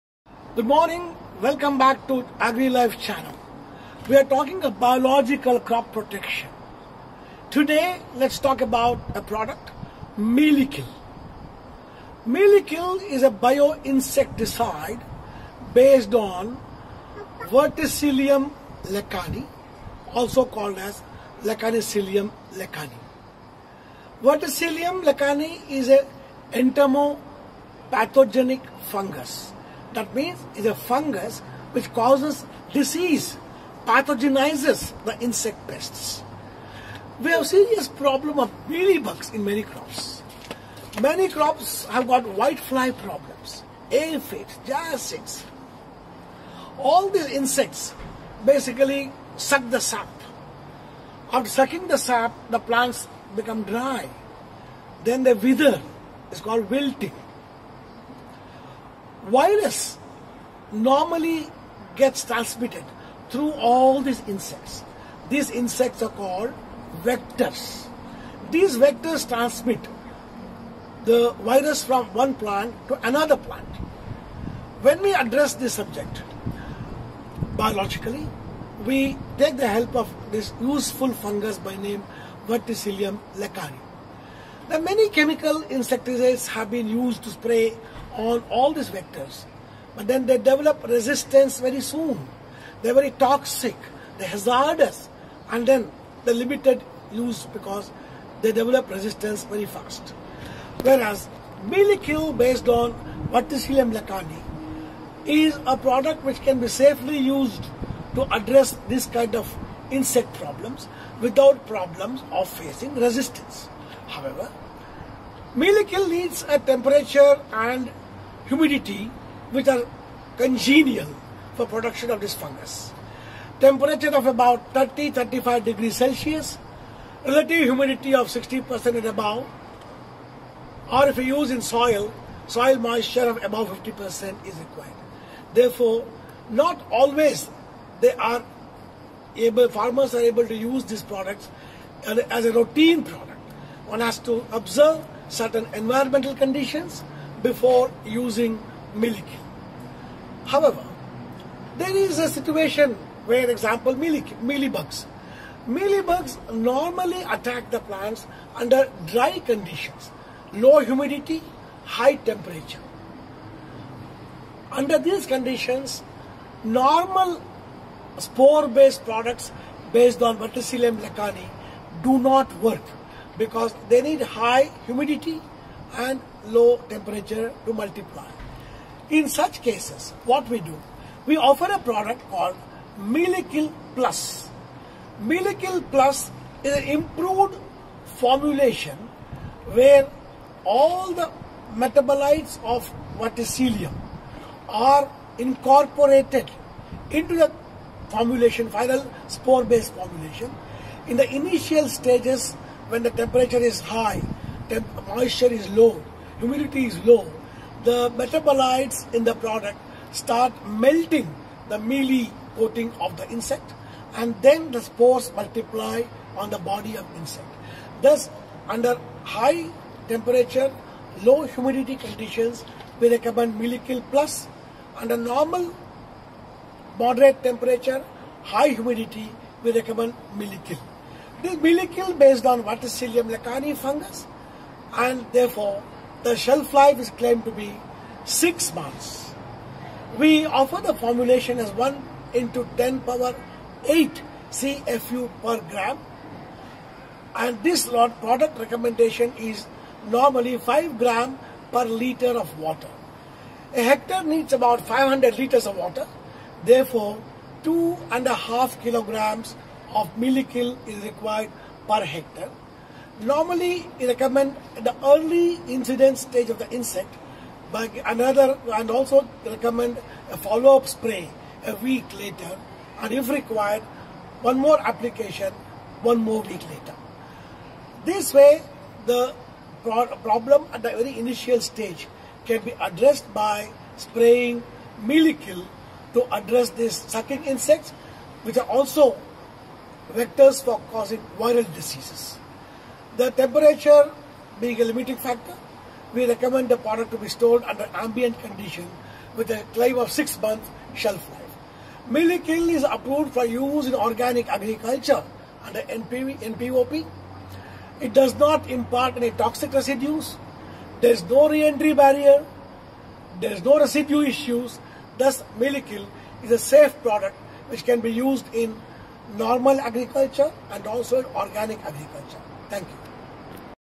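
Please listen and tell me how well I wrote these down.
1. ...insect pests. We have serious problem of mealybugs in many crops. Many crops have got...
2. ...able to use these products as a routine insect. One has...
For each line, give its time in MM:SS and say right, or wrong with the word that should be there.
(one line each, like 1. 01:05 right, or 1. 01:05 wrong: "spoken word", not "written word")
1. 00:35 right
2. 02:20 wrong: "product", not "insect".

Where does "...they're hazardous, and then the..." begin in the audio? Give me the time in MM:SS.
01:34.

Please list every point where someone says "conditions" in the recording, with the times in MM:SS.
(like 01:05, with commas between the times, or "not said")
02:26, 02:39, 02:45, 03:41, 04:58.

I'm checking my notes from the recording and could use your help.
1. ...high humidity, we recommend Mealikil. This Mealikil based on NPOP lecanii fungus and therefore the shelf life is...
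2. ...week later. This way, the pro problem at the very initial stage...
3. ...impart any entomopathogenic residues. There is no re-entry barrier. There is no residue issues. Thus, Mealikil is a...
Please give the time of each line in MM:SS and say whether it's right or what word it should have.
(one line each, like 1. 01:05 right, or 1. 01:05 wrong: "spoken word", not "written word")
1. 03:48 wrong: "Verticillium", not "NPOP"
2. 04:36 right
3. 05:08 wrong: "toxic", not "entomopathogenic".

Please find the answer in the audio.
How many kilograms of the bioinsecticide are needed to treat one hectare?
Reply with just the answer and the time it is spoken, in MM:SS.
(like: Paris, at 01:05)
2.5 kilograms, at 04:17.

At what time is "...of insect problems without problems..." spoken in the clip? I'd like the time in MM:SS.
01:49.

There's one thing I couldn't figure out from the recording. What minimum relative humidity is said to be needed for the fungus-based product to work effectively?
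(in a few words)
60%.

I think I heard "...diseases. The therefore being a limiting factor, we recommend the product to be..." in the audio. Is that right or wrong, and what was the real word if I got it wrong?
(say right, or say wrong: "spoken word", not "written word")
wrong: "temperature", not "therefore".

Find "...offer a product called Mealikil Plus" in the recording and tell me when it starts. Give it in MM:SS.
03:01.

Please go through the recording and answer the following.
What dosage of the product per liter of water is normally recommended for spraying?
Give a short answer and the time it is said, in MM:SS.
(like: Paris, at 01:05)
5 grams, at 04:10.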